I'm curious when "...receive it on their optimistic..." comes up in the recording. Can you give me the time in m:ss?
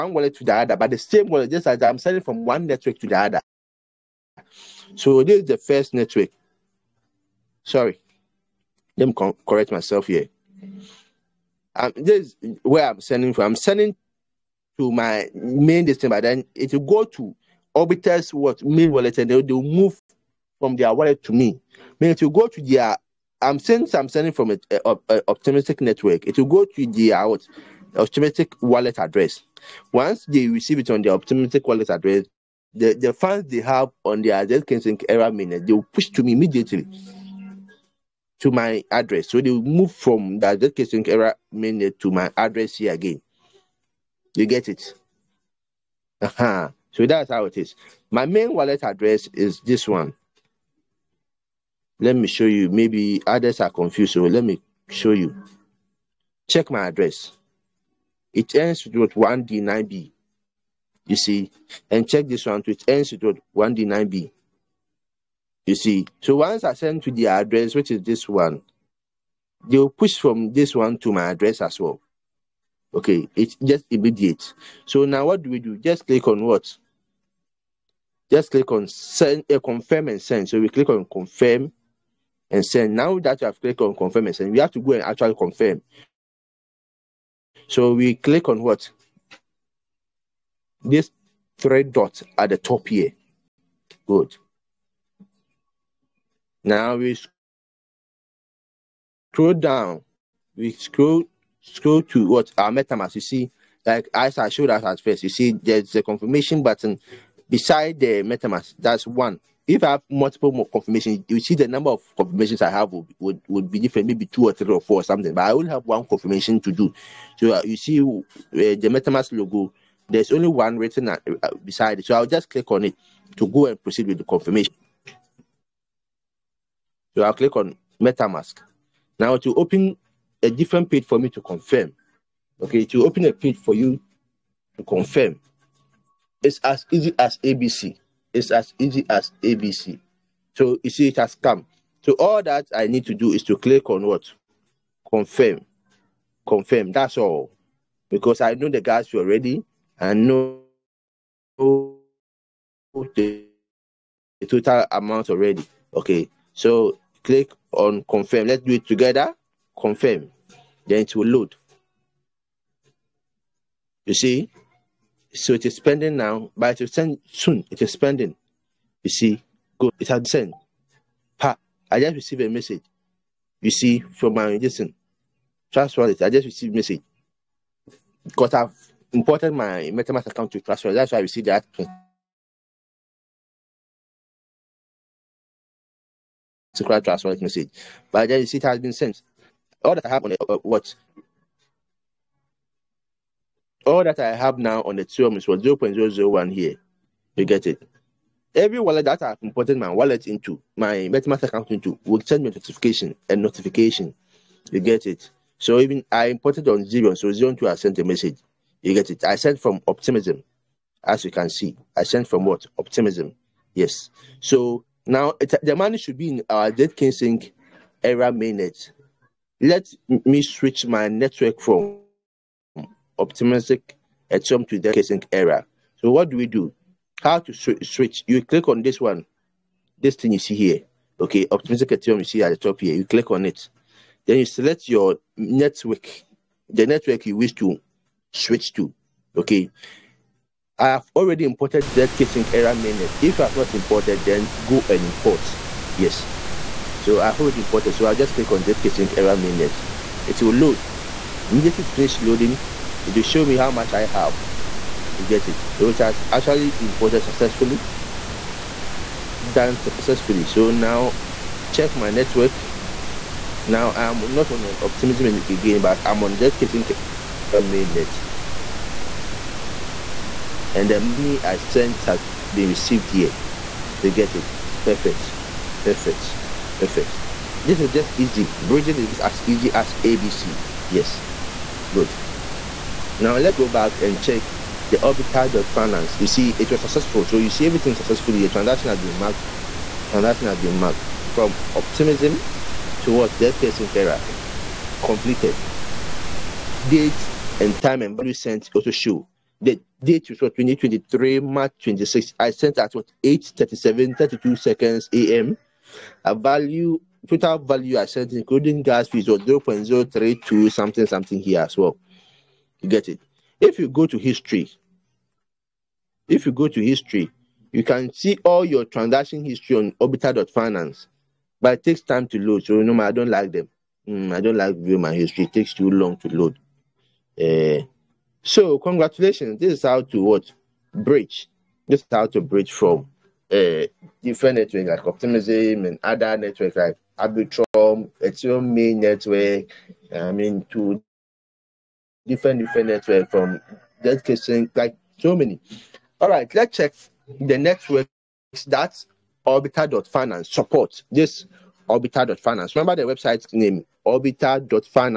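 0:30.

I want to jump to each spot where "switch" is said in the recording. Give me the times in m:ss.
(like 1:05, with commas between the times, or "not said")
3:40, 3:47, 3:58.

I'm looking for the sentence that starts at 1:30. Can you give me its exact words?
This three dots at the top here.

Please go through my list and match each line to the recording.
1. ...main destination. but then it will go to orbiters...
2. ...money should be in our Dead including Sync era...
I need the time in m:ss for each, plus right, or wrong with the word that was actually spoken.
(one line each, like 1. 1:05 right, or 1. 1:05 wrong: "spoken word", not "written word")
1. 0:15 right
2. 3:35 wrong: "casing", not "including".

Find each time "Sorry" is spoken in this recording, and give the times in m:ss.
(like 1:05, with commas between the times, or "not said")
0:07.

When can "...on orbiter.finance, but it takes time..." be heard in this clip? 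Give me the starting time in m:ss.
5:19.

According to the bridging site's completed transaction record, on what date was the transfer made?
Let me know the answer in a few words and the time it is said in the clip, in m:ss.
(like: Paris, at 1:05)
March 26, 2023, at 5:00.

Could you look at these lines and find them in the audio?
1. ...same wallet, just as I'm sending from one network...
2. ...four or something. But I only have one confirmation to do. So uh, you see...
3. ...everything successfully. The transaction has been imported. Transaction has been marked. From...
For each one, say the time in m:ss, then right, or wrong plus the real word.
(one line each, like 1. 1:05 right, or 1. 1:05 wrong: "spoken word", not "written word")
1. 0:00 right
2. 1:54 right
3. 4:47 wrong: "marked", not "imported".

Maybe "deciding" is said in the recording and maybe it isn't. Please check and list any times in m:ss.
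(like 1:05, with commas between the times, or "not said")
not said.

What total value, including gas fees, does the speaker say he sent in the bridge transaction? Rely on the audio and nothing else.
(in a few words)
0.032.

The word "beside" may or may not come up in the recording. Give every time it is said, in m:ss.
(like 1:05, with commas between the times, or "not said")
1:47, 2:01.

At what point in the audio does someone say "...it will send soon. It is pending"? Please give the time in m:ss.
2:46.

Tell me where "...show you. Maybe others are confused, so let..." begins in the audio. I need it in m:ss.
0:52.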